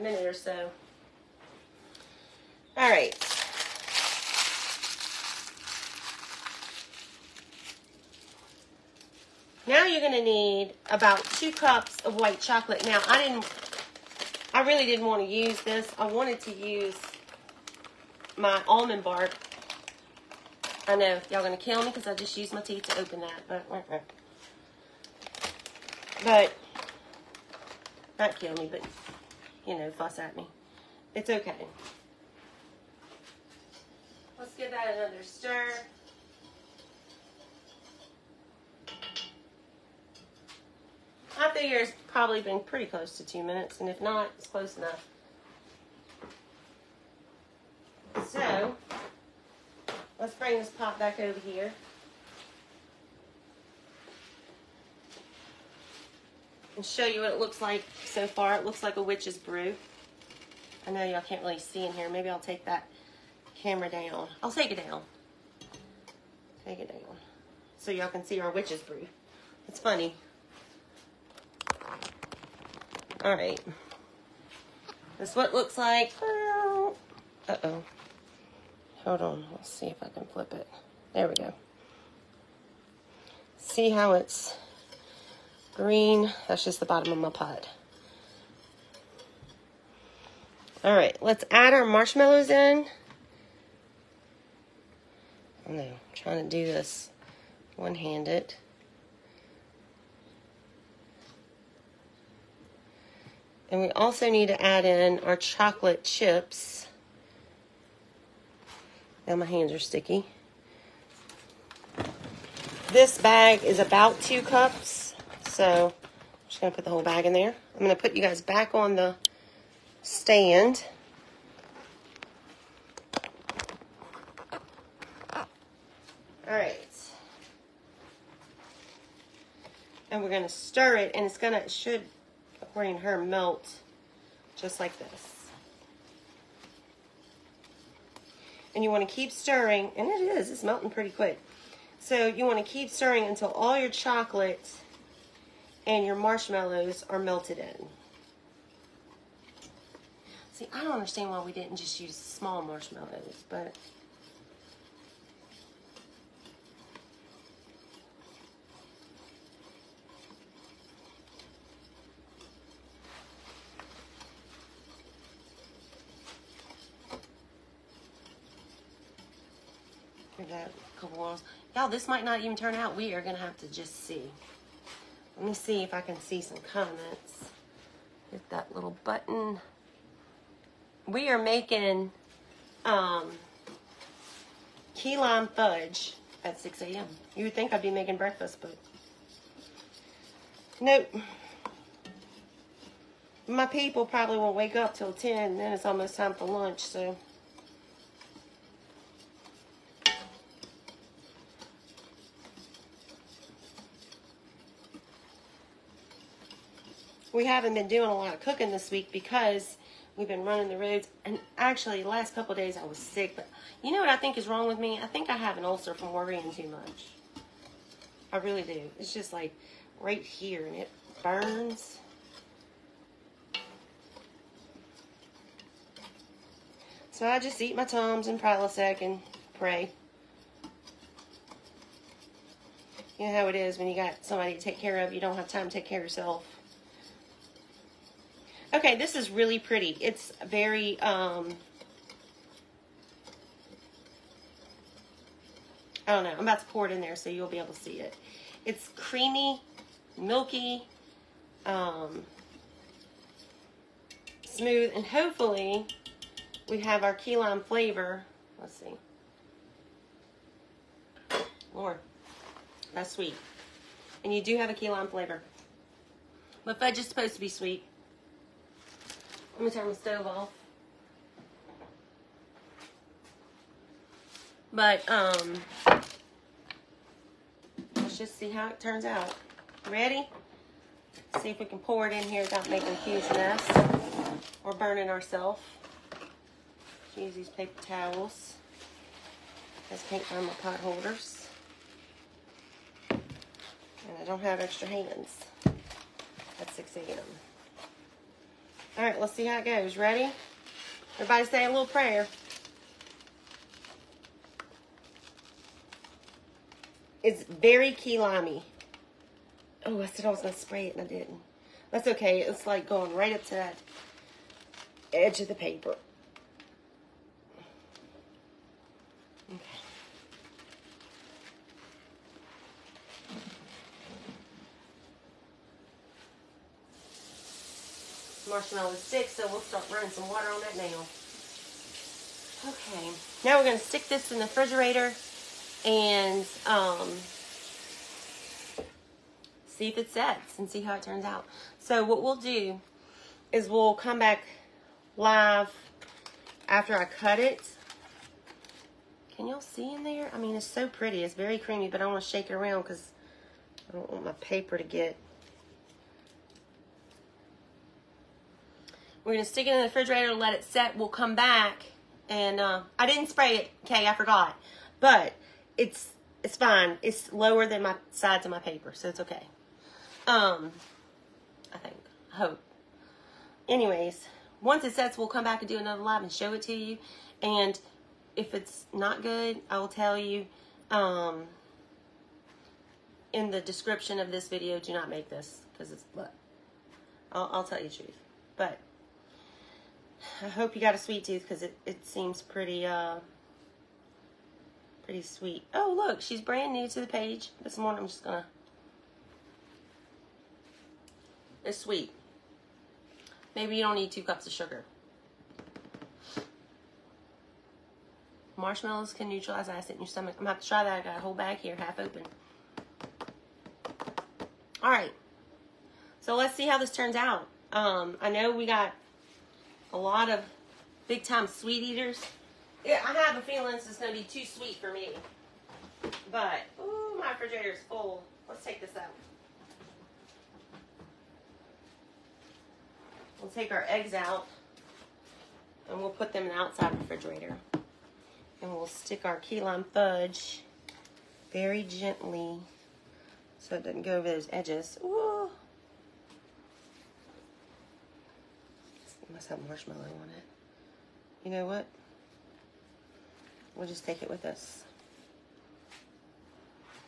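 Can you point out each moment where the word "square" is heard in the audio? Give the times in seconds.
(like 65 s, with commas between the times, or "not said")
not said.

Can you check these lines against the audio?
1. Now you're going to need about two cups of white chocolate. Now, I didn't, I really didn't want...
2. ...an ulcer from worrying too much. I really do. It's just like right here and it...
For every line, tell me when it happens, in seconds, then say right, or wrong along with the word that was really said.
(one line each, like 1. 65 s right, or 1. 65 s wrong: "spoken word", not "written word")
1. 9 s right
2. 215 s right.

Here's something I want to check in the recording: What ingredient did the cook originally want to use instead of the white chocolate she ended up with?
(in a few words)
almond bark.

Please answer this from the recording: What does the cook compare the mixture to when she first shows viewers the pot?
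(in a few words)
a witch's brew.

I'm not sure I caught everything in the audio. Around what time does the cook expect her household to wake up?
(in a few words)
10.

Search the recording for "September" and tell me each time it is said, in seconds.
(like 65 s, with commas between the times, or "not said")
not said.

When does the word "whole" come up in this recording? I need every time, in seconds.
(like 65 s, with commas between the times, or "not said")
116 s, 411 s.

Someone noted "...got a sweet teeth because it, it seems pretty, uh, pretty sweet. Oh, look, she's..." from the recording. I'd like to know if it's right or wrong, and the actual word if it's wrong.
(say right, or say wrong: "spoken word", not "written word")
wrong: "tooth", not "teeth".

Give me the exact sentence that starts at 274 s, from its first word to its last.
But, um, let's just see how it turns out.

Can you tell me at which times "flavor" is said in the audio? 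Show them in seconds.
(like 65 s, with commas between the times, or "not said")
257 s, 265 s.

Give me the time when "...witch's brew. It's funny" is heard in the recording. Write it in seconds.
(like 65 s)
68 s.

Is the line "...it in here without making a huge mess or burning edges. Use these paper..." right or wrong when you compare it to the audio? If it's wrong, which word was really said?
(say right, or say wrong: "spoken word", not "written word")
wrong: "ourselves", not "edges".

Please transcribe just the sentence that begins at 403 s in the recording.
Maybe you don't need two cups of sugar.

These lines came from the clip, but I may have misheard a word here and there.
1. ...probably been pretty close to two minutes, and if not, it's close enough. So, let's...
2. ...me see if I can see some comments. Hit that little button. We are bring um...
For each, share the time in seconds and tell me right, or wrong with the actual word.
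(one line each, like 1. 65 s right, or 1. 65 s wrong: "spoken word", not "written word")
1. 42 s right
2. 175 s wrong: "making", not "bring".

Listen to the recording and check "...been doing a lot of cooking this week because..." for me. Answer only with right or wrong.
right.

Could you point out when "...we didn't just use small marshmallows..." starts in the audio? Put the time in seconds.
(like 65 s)
151 s.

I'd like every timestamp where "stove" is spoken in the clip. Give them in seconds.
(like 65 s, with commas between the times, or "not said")
269 s.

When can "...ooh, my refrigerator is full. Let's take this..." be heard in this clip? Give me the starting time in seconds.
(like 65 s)
426 s.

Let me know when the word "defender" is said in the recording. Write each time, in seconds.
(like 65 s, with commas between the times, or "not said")
not said.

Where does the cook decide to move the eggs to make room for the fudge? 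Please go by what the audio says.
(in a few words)
the outside refrigerator.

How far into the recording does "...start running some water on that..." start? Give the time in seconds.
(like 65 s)
329 s.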